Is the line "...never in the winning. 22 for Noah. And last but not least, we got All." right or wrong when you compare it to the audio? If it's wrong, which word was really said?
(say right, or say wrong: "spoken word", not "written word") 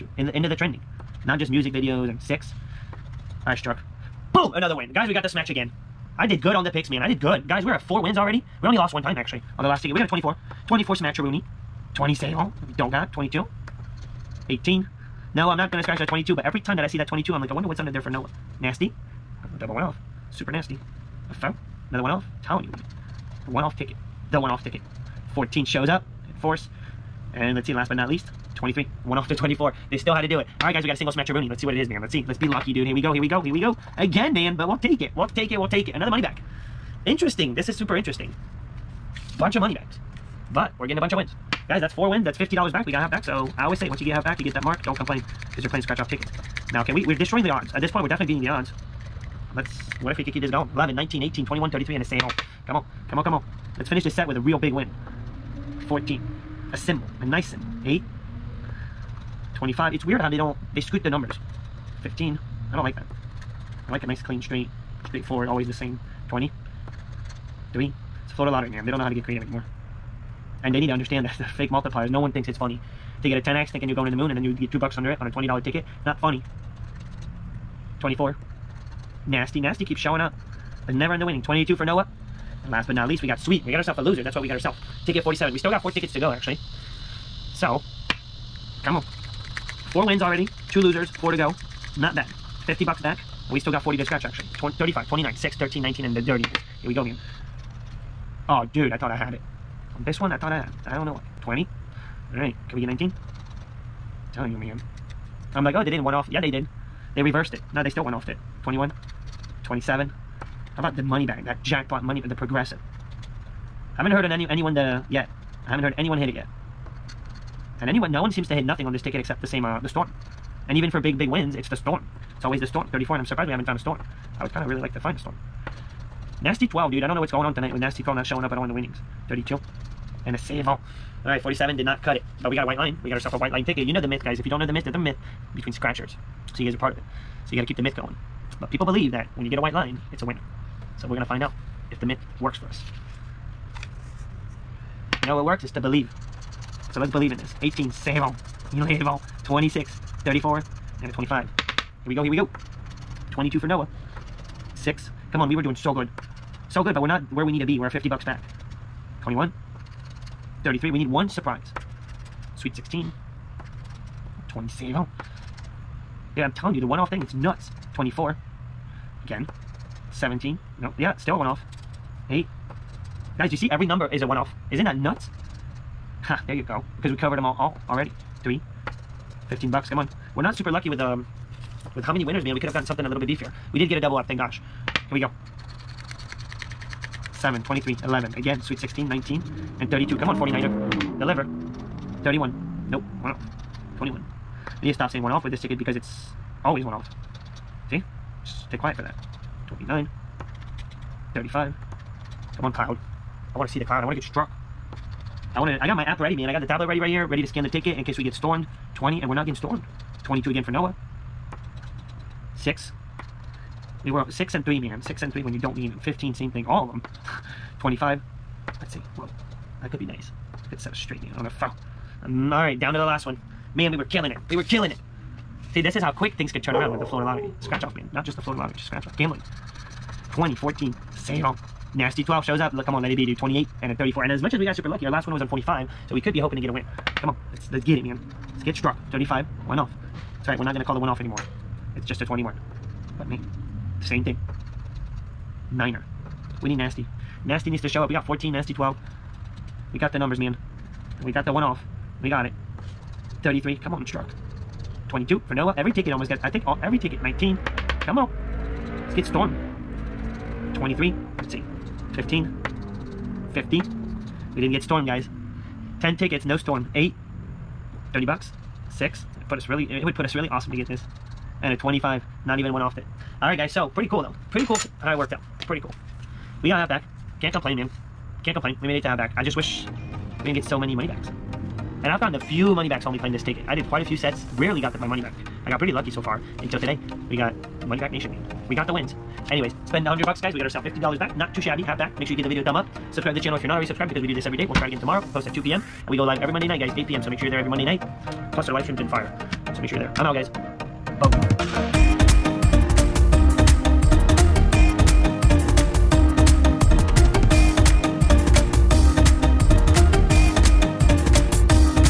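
wrong: "Sweet", not "All".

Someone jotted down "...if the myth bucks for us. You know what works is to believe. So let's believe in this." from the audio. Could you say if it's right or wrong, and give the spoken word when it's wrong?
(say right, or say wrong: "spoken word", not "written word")
wrong: "works", not "bucks".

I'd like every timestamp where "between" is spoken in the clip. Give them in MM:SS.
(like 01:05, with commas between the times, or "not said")
02:15.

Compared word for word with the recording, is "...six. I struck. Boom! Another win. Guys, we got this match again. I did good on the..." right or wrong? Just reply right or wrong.
right.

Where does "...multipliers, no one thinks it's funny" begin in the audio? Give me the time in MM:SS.
01:11.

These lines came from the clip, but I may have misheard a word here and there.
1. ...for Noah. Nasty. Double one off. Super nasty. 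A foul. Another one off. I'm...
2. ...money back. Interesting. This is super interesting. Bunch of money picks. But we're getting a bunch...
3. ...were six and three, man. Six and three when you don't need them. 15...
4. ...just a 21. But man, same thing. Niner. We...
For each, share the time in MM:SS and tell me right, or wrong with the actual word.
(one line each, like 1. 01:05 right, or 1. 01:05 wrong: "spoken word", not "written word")
1. 00:18 right
2. 00:36 wrong: "backs", not "picks"
3. 03:34 right
4. 04:02 right.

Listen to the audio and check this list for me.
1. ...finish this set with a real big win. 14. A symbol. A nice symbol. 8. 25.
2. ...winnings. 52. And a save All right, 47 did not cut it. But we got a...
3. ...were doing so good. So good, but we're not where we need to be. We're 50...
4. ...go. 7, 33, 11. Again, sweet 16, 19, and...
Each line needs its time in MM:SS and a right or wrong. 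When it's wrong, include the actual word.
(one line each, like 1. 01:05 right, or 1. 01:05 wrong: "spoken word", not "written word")
1. 00:53 right
2. 02:08 wrong: "32", not "52"
3. 02:35 right
4. 03:05 wrong: "23", not "33".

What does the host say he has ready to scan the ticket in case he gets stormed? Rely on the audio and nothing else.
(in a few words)
The tablet.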